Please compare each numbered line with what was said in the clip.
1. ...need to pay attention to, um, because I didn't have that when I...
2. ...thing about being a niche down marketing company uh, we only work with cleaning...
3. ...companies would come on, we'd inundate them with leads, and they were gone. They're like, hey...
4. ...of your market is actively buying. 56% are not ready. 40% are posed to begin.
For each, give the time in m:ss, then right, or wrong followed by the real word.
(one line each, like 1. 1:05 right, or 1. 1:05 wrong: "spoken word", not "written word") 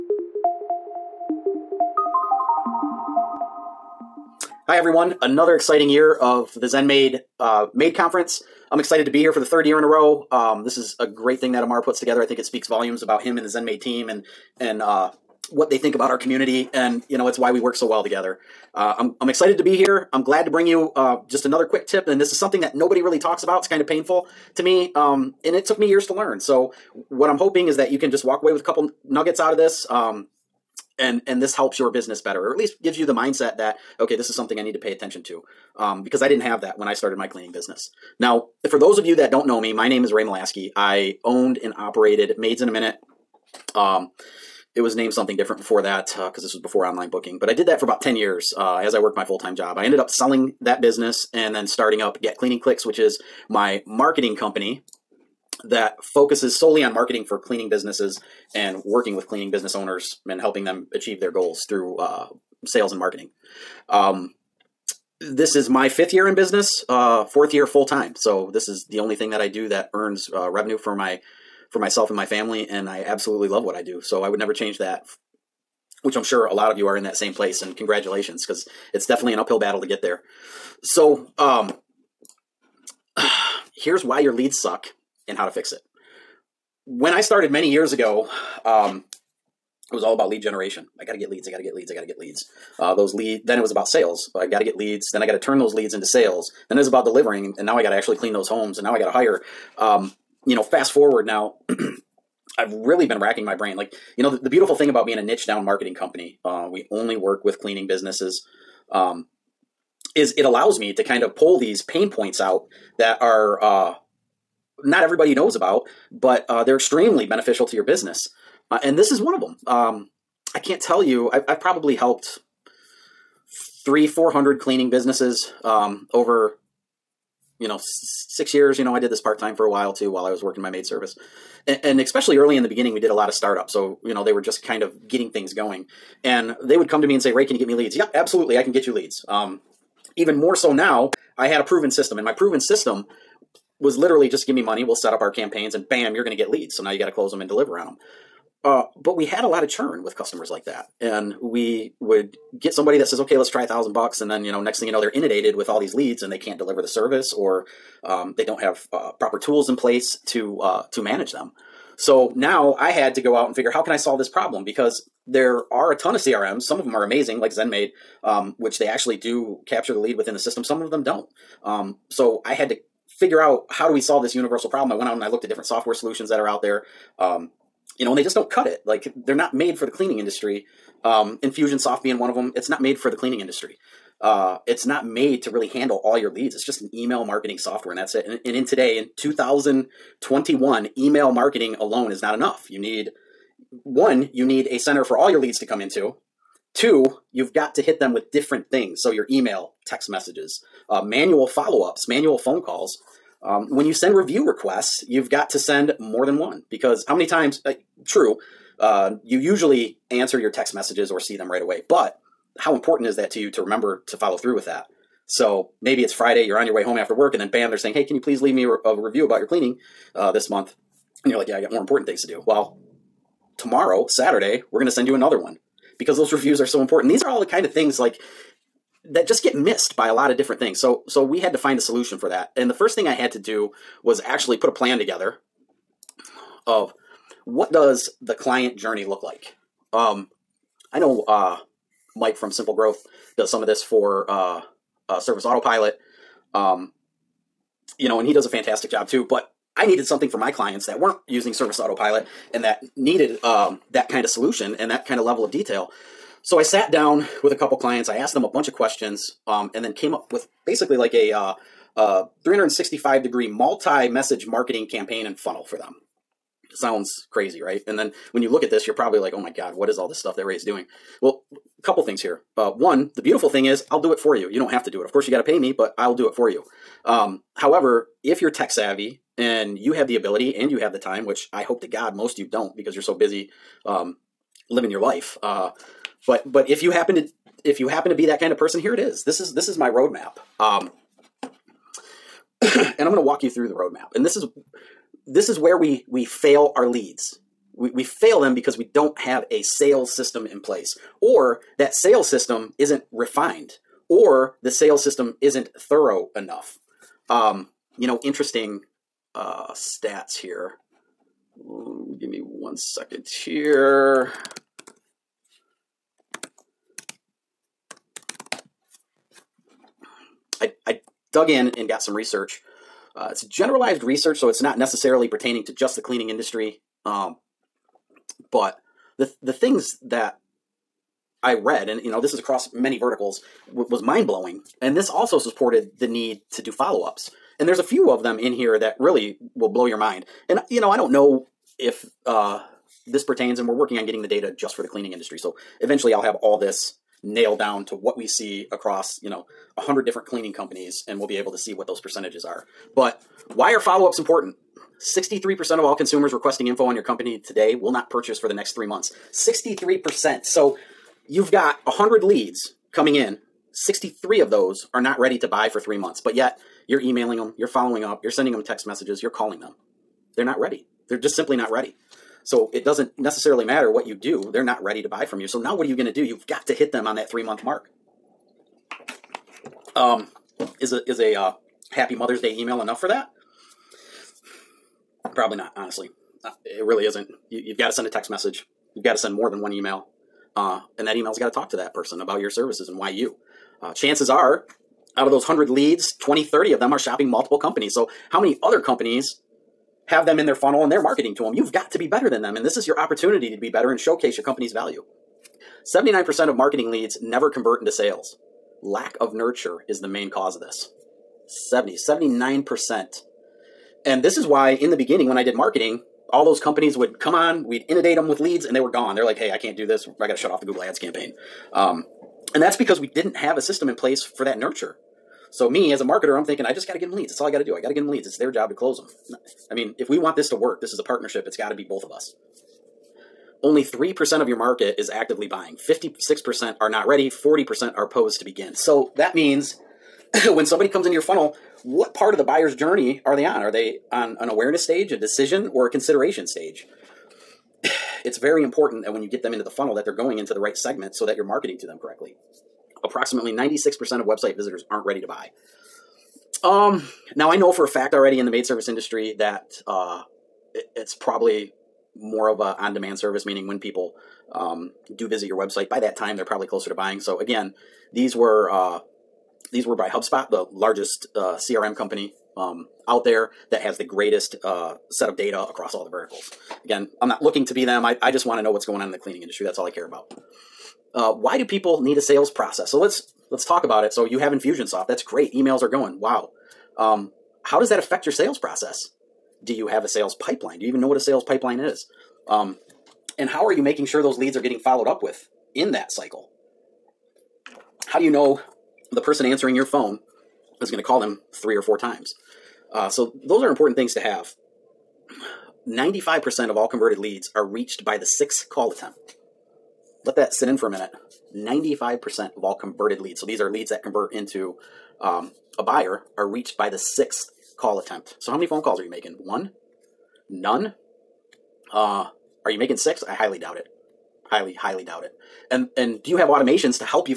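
1. 0:34 right
2. 1:44 right
3. 6:56 right
4. 7:14 right.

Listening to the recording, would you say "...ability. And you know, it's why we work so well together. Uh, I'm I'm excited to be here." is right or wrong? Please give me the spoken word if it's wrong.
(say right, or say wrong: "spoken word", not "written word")
wrong: "community", not "ability".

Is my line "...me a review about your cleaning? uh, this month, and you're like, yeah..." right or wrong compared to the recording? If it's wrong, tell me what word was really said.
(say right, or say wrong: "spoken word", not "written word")
right.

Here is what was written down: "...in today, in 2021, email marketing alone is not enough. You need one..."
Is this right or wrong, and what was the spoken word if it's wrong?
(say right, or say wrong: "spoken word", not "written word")
right.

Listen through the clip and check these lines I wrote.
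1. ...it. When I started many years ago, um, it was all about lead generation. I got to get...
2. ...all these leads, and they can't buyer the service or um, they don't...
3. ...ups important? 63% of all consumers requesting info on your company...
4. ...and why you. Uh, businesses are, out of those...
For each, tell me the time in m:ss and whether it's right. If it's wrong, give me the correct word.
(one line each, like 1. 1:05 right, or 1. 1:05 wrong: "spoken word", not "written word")
1. 1:25 right
2. 2:35 wrong: "deliver", not "buyer"
3. 5:54 right
4. 6:32 wrong: "chances", not "businesses".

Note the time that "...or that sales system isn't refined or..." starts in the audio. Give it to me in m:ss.
5:01.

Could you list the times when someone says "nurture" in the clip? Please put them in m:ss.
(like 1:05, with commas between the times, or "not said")
6:49, 7:04.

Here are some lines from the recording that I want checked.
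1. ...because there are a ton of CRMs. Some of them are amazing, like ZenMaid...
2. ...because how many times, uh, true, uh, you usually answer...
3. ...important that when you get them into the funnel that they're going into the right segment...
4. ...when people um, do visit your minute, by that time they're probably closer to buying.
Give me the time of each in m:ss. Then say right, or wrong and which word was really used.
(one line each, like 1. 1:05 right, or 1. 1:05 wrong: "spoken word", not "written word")
1. 2:44 right
2. 3:26 right
3. 7:28 right
4. 7:43 wrong: "website", not "minute".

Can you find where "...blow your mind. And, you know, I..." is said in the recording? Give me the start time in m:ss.
5:39.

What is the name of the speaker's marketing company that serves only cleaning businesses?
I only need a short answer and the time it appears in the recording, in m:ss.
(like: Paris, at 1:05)
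Get Cleaning Clicks, at 0:52.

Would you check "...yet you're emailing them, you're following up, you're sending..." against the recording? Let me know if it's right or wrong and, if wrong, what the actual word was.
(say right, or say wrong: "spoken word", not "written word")
right.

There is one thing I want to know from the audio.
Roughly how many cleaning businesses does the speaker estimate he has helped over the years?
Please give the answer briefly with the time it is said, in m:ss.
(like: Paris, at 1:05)
300 to 400, at 2:03.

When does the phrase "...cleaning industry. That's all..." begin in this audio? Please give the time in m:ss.
7:59.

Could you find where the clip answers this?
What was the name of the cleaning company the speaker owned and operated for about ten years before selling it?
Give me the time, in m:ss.
0:42.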